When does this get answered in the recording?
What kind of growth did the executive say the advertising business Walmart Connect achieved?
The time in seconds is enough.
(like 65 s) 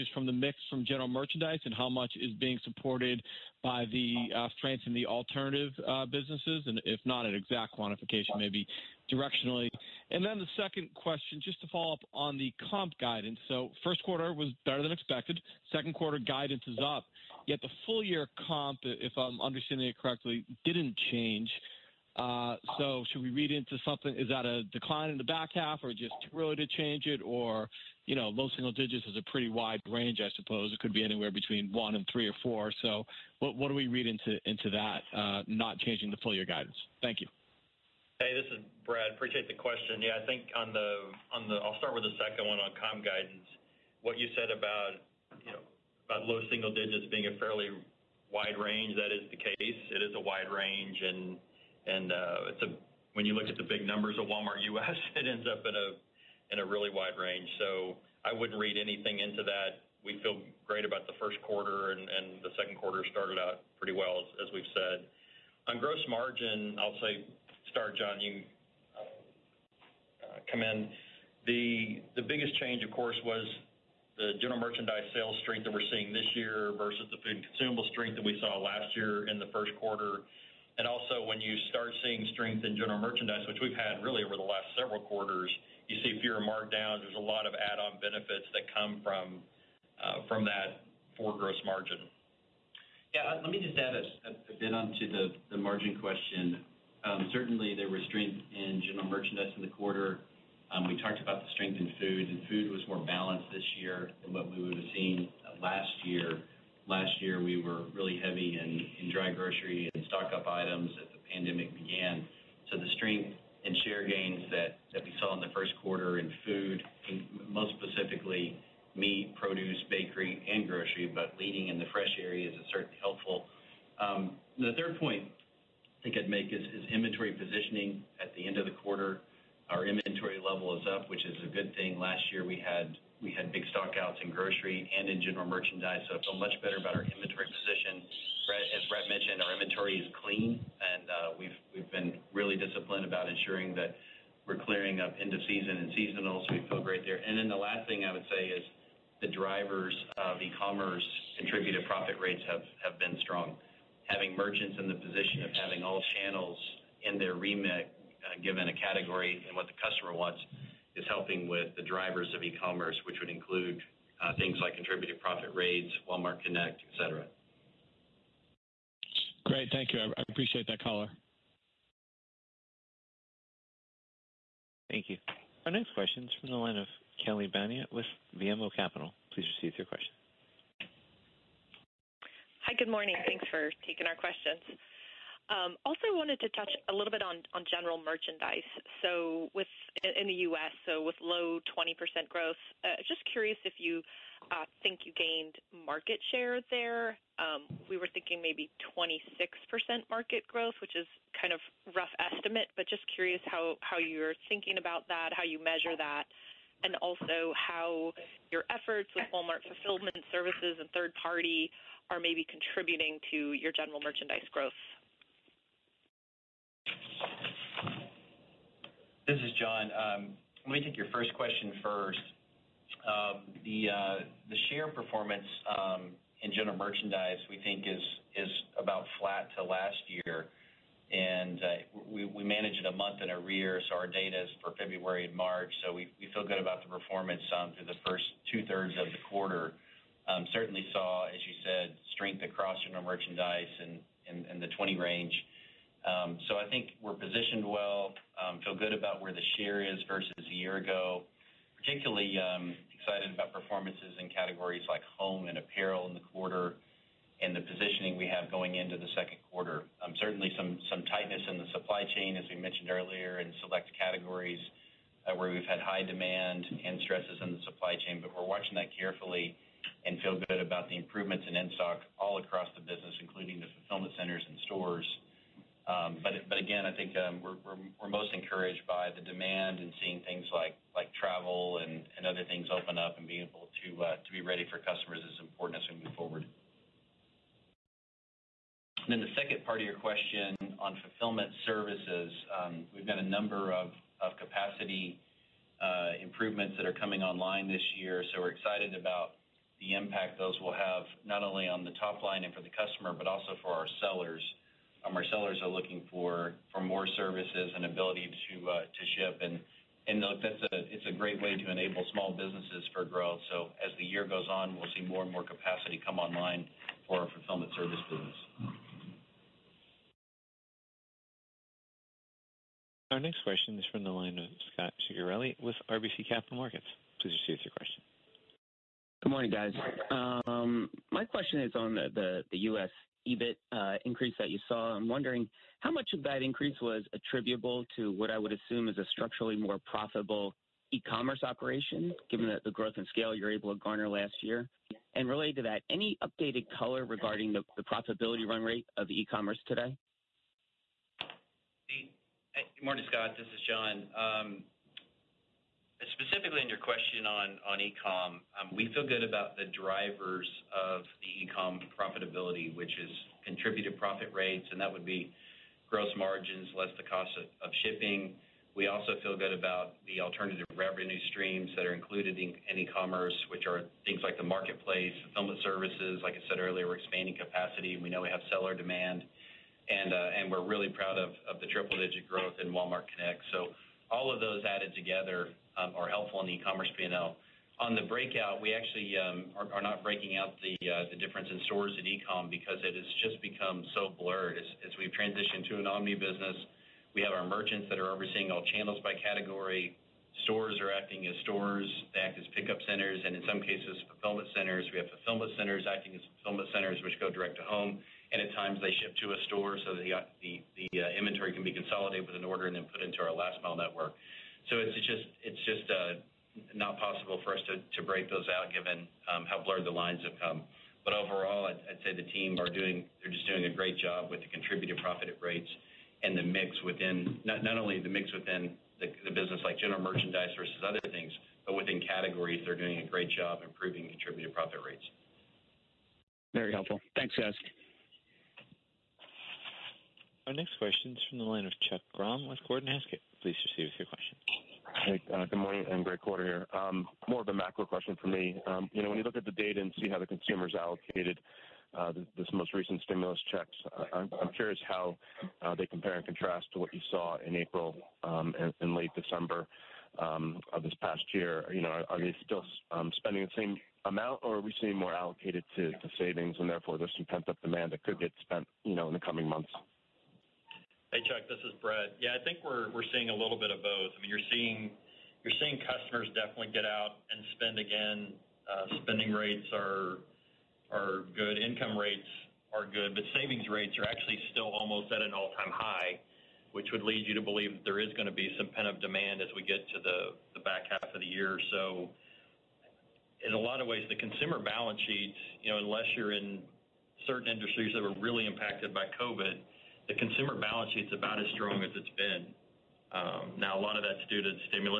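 381 s.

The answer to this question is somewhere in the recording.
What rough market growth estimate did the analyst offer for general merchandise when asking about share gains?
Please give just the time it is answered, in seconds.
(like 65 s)
198 s.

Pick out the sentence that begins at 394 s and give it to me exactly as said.
As we've transitioned to an omni business, we have our merchants that are overseeing all channels by category.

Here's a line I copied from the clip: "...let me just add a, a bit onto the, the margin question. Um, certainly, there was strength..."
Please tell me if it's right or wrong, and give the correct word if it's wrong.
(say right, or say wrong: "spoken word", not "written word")
right.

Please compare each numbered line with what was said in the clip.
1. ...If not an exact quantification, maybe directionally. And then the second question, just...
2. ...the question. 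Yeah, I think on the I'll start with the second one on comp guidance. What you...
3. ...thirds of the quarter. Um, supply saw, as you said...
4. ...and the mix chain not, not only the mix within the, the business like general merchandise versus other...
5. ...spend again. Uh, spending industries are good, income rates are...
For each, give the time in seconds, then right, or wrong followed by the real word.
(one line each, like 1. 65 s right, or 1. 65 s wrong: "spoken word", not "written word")
1. 6 s right
2. 39 s right
3. 238 s wrong: "certainly", not "supply"
4. 426 s wrong: "within", not "chain"
5. 477 s wrong: "rates", not "industries".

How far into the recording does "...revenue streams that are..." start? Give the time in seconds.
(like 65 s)
370 s.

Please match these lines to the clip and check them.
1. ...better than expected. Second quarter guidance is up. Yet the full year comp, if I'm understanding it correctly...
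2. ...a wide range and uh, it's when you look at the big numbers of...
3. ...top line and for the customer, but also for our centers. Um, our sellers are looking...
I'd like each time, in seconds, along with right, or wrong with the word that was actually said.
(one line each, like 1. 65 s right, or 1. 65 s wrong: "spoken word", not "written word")
1. 14 s right
2. 50 s right
3. 301 s wrong: "sellers", not "centers".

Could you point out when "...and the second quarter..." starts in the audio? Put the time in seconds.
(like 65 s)
61 s.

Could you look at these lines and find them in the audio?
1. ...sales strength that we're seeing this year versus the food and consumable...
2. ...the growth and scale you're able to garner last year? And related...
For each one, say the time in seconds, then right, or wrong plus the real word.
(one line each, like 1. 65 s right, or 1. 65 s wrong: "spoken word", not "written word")
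1. 75 s right
2. 342 s right.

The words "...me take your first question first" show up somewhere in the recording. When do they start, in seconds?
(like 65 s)
220 s.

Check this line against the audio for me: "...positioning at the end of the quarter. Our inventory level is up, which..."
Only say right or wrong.
right.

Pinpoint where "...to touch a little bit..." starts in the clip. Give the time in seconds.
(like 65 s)
186 s.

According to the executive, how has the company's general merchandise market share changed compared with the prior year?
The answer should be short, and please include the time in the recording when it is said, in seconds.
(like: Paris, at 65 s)
About flat, at 228 s.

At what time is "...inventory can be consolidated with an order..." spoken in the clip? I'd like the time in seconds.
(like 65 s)
411 s.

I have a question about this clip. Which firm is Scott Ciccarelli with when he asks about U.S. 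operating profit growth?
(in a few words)
RBC Capital Markets.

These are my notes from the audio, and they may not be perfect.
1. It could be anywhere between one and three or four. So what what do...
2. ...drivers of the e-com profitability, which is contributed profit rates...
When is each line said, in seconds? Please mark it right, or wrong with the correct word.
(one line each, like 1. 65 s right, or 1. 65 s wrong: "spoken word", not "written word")
1. 30 s right
2. 359 s right.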